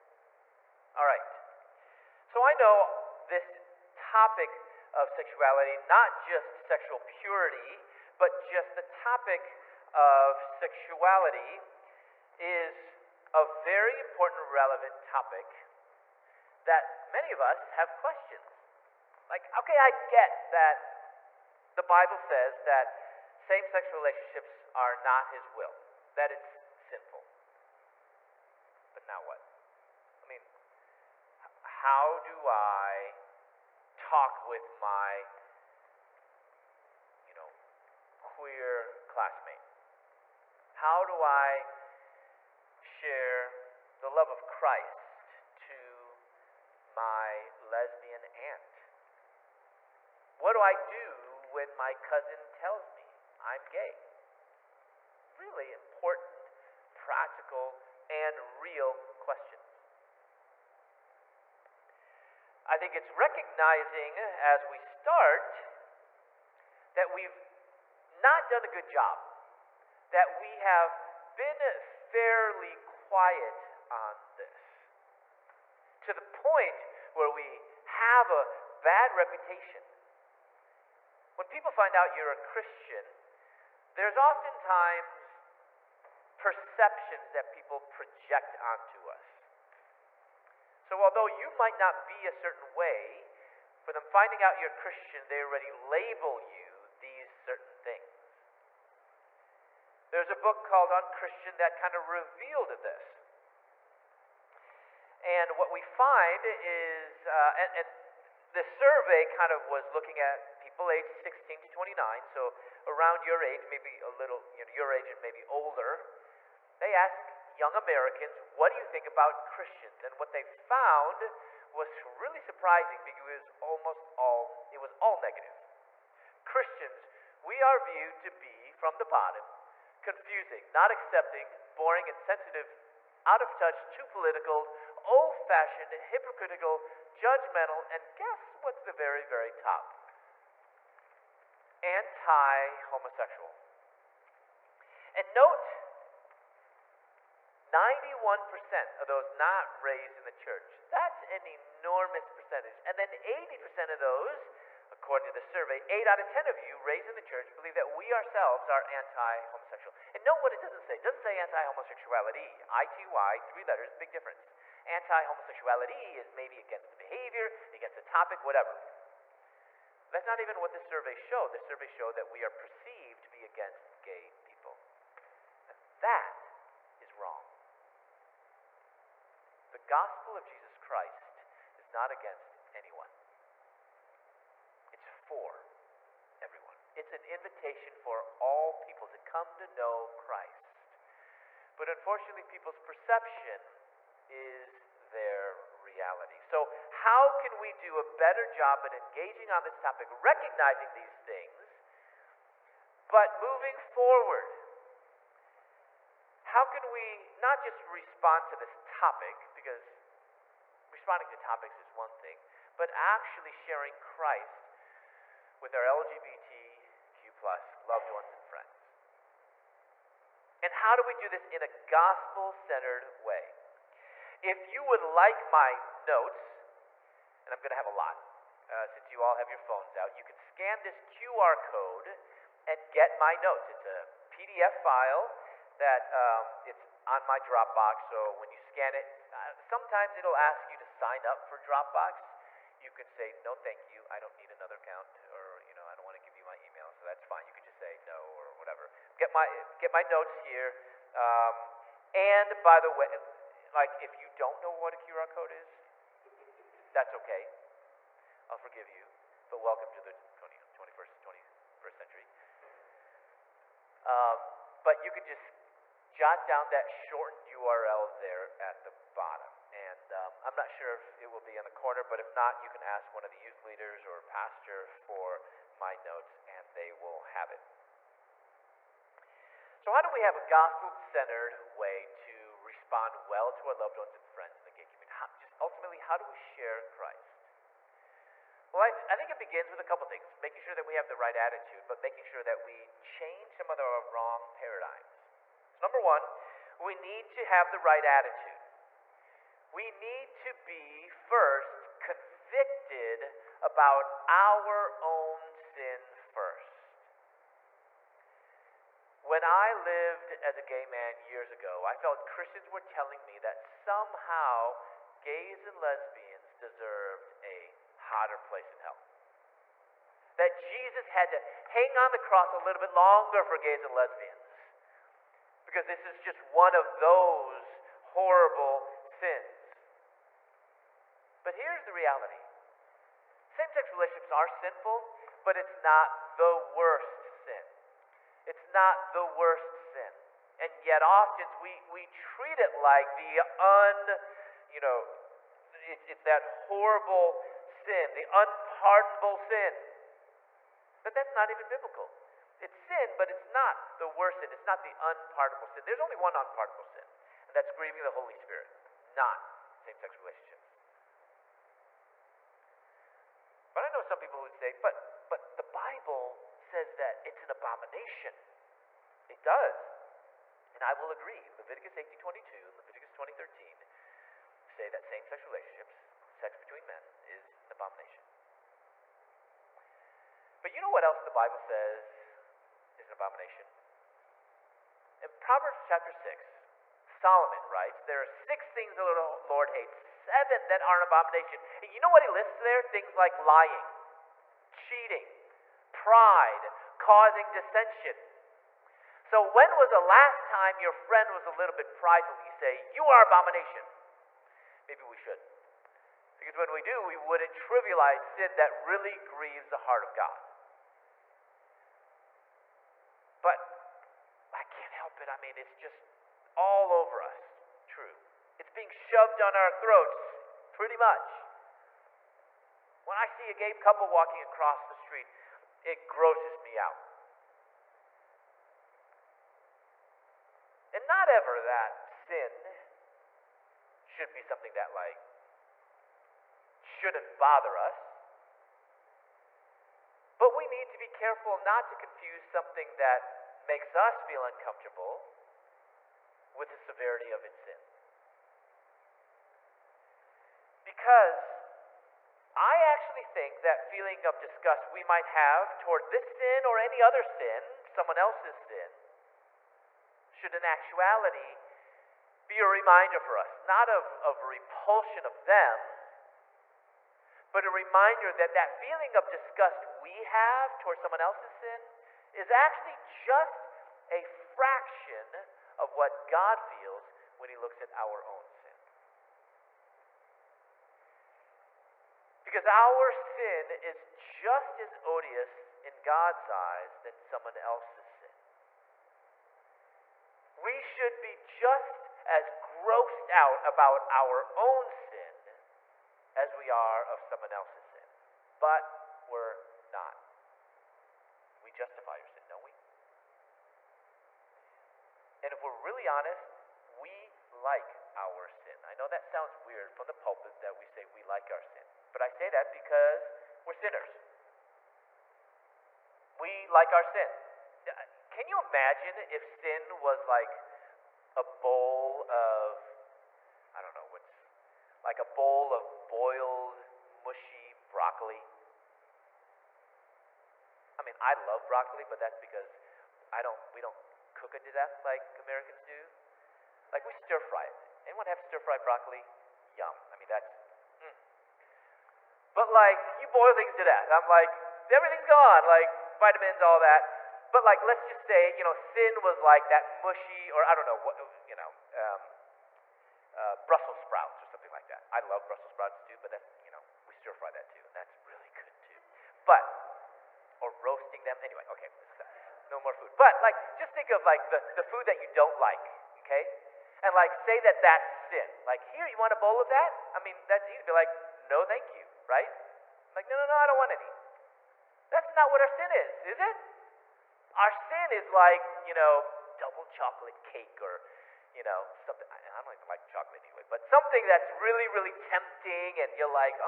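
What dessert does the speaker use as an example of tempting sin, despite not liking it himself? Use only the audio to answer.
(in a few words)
double chocolate cake.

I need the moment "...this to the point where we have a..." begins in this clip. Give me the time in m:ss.
1:14.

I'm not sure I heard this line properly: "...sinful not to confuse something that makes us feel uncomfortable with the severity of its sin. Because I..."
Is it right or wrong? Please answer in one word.
wrong.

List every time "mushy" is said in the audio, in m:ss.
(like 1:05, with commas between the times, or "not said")
8:47, 9:10.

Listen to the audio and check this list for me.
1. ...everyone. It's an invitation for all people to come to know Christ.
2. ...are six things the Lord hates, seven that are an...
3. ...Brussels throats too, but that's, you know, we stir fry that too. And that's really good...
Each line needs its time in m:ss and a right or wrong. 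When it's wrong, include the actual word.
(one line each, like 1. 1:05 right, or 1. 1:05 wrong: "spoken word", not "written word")
1. 3:06 right
2. 6:28 right
3. 9:15 wrong: "sprouts", not "throats".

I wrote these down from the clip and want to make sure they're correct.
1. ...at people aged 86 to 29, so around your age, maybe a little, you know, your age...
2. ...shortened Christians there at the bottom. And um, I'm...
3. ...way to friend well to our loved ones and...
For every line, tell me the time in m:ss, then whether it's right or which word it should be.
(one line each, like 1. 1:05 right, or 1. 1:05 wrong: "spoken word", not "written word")
1. 1:50 wrong: "16", not "86"
2. 4:26 wrong: "URL", not "Christians"
3. 4:41 wrong: "respond", not "friend".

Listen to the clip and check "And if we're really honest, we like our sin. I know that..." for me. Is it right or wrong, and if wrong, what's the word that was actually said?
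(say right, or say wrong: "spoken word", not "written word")
right.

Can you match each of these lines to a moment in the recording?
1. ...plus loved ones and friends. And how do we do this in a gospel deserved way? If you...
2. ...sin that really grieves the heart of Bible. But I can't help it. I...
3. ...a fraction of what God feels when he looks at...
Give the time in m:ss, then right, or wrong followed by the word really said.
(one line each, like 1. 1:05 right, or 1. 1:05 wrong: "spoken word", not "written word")
1. 3:37 wrong: "centered", not "deserved"
2. 6:48 wrong: "God", not "Bible"
3. 7:54 right.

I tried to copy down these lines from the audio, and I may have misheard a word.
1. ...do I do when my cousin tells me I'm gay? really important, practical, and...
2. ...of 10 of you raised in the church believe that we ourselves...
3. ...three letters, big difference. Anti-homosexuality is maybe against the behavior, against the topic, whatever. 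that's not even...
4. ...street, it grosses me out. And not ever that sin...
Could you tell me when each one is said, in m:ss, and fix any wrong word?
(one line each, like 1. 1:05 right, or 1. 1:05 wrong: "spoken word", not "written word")
1. 0:50 right
2. 2:36 right
3. 2:43 right
4. 7:04 right.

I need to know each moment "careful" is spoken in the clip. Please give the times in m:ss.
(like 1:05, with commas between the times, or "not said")
7:21.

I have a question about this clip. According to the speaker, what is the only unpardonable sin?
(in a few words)
grieving the Holy Spirit.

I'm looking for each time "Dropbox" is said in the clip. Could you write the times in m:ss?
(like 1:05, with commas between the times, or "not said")
3:57, 4:01.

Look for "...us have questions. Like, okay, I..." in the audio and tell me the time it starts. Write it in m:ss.
0:17.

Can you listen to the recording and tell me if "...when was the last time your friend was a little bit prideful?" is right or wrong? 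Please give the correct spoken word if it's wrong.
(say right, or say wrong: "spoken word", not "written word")
right.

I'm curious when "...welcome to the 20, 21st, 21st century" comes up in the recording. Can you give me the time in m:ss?
4:19.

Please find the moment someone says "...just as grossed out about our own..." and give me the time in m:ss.
8:11.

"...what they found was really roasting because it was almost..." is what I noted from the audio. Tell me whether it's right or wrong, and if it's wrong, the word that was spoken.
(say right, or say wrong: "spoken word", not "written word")
wrong: "surprising", not "roasting".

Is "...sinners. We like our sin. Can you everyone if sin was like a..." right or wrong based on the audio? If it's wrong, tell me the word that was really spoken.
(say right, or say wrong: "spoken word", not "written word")
wrong: "imagine", not "everyone".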